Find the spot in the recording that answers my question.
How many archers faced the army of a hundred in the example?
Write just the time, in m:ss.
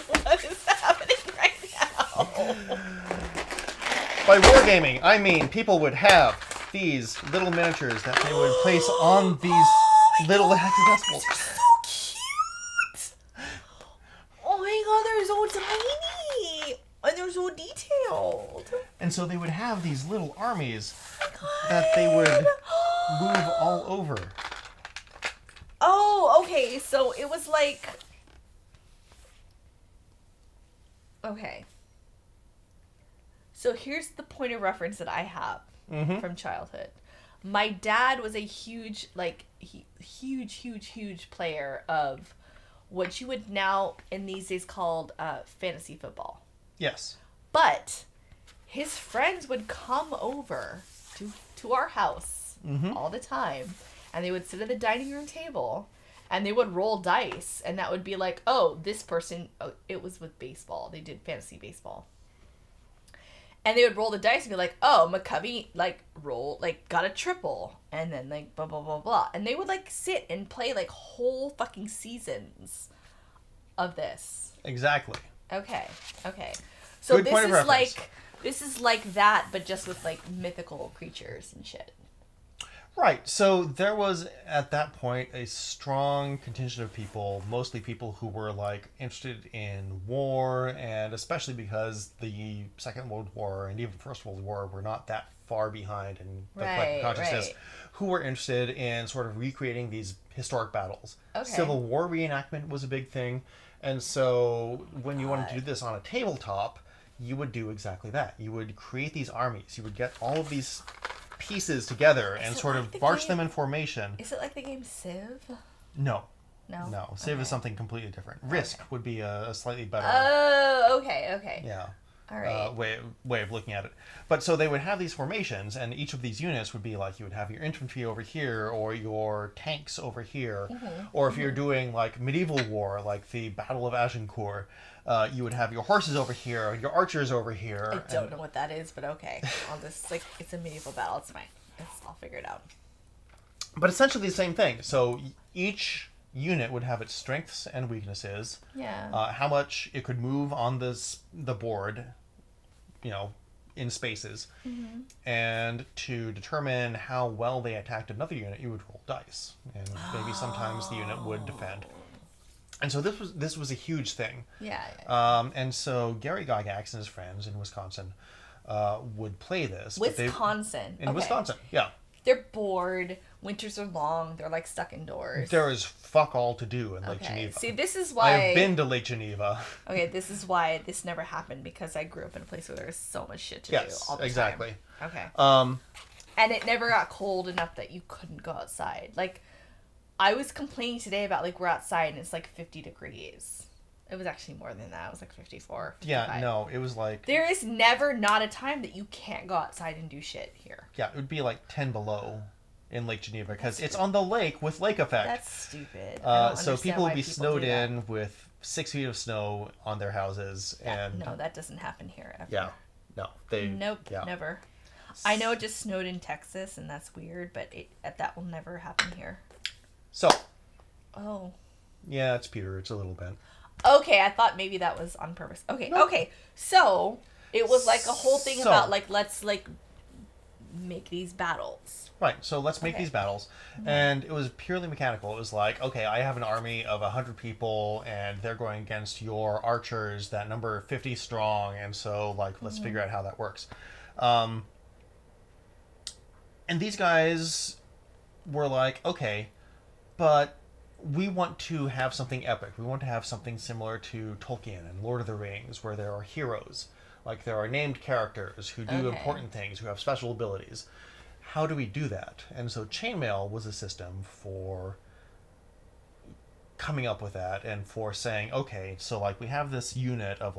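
4:00.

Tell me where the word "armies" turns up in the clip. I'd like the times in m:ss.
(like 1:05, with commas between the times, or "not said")
0:20, 1:49.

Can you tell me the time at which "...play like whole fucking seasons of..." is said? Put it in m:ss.
1:10.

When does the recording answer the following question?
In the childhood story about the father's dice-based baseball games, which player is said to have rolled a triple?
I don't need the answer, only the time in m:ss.
1:05.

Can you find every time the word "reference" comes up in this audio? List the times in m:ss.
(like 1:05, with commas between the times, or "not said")
0:34.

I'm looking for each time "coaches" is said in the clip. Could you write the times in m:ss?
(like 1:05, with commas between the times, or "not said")
not said.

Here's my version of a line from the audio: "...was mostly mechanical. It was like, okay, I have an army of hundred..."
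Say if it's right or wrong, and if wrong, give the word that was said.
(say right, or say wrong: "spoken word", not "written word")
wrong: "purely", not "mostly".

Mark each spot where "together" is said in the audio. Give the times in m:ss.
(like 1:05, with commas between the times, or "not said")
1:51.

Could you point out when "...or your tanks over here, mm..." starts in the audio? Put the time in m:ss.
2:08.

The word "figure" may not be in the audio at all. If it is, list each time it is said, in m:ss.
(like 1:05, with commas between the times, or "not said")
2:22, 4:02.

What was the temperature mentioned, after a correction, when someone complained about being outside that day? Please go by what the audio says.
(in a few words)
54 degrees.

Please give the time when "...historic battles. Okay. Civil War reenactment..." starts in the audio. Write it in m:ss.
1:40.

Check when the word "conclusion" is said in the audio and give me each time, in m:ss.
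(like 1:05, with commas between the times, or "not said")
not said.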